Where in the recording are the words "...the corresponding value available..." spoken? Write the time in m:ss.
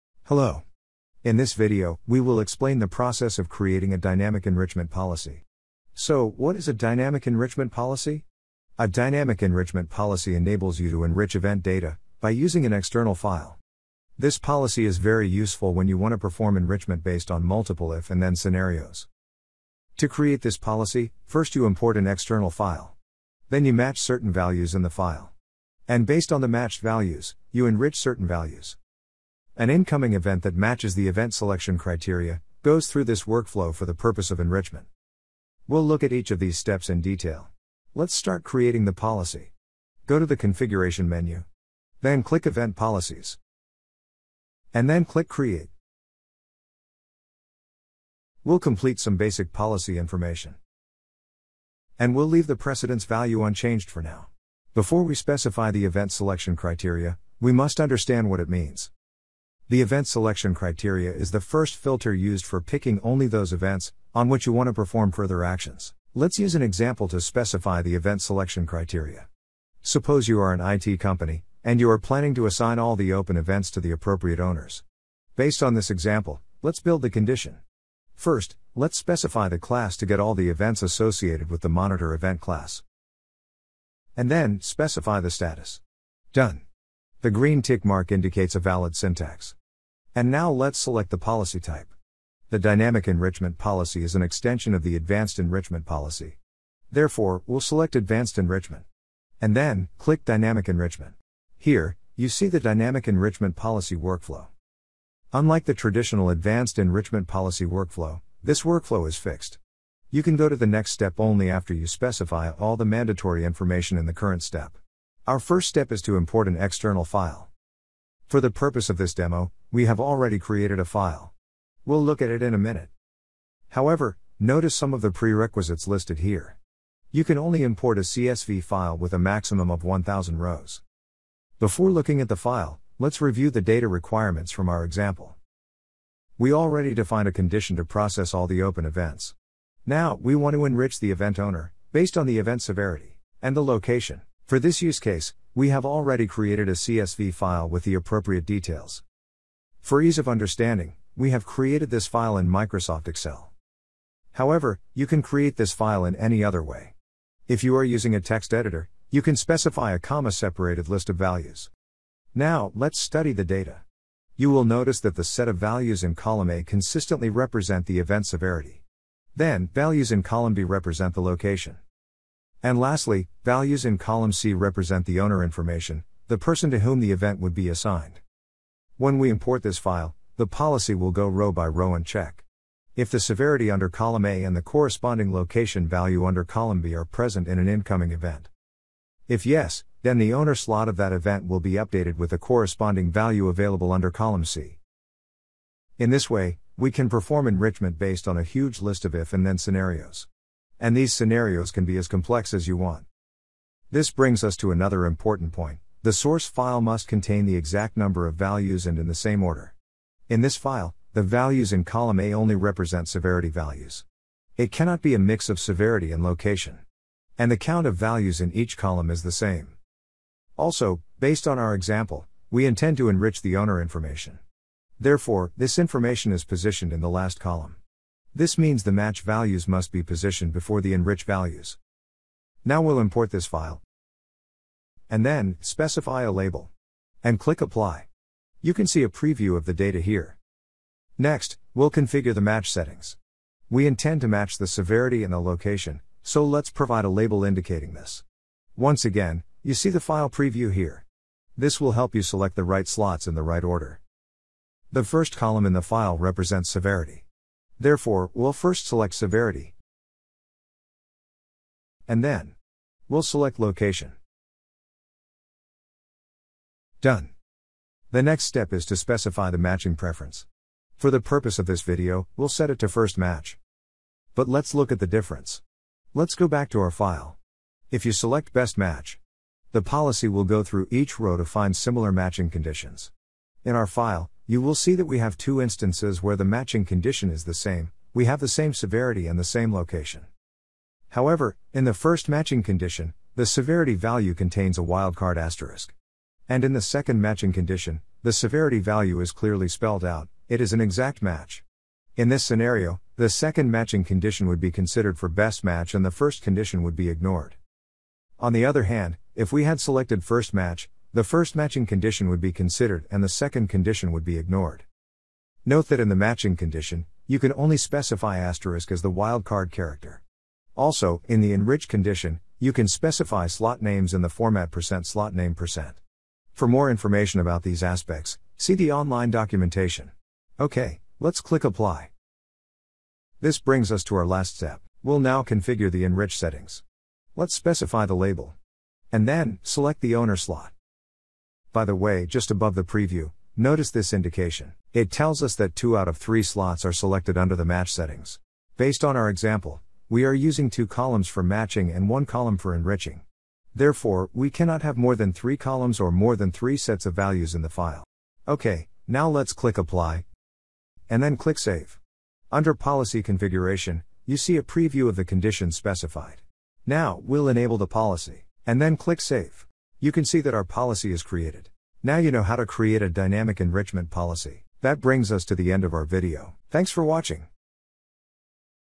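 3:12.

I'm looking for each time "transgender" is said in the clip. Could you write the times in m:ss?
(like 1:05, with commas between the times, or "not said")
not said.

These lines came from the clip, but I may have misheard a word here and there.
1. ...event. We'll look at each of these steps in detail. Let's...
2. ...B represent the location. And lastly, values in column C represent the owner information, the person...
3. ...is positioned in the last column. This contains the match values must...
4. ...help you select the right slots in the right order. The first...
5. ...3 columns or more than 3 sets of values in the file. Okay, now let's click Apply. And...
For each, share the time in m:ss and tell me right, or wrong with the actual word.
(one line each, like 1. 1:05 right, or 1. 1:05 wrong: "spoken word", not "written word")
1. 0:34 wrong: "enrichment", not "event"
2. 2:50 right
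3. 3:46 wrong: "means", not "contains"
4. 4:11 right
5. 5:55 right.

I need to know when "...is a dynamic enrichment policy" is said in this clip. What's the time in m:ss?
0:06.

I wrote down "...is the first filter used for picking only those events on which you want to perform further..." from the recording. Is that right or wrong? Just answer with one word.
right.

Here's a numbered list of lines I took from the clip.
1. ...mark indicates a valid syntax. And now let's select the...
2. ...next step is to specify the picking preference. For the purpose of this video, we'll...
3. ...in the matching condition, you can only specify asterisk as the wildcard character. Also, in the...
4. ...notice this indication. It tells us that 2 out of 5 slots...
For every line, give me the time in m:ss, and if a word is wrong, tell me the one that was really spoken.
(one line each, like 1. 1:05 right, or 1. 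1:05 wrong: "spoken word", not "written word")
1. 1:27 right
2. 4:28 wrong: "matching", not "picking"
3. 5:15 right
4. 5:43 wrong: "3", not "5".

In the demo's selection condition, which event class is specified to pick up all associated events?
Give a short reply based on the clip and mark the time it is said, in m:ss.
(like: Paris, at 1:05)
monitor event class, at 1:21.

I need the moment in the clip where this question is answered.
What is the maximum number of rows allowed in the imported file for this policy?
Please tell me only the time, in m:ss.
2:09.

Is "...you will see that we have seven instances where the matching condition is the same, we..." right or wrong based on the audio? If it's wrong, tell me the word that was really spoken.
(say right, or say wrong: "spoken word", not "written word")
wrong: "two", not "seven".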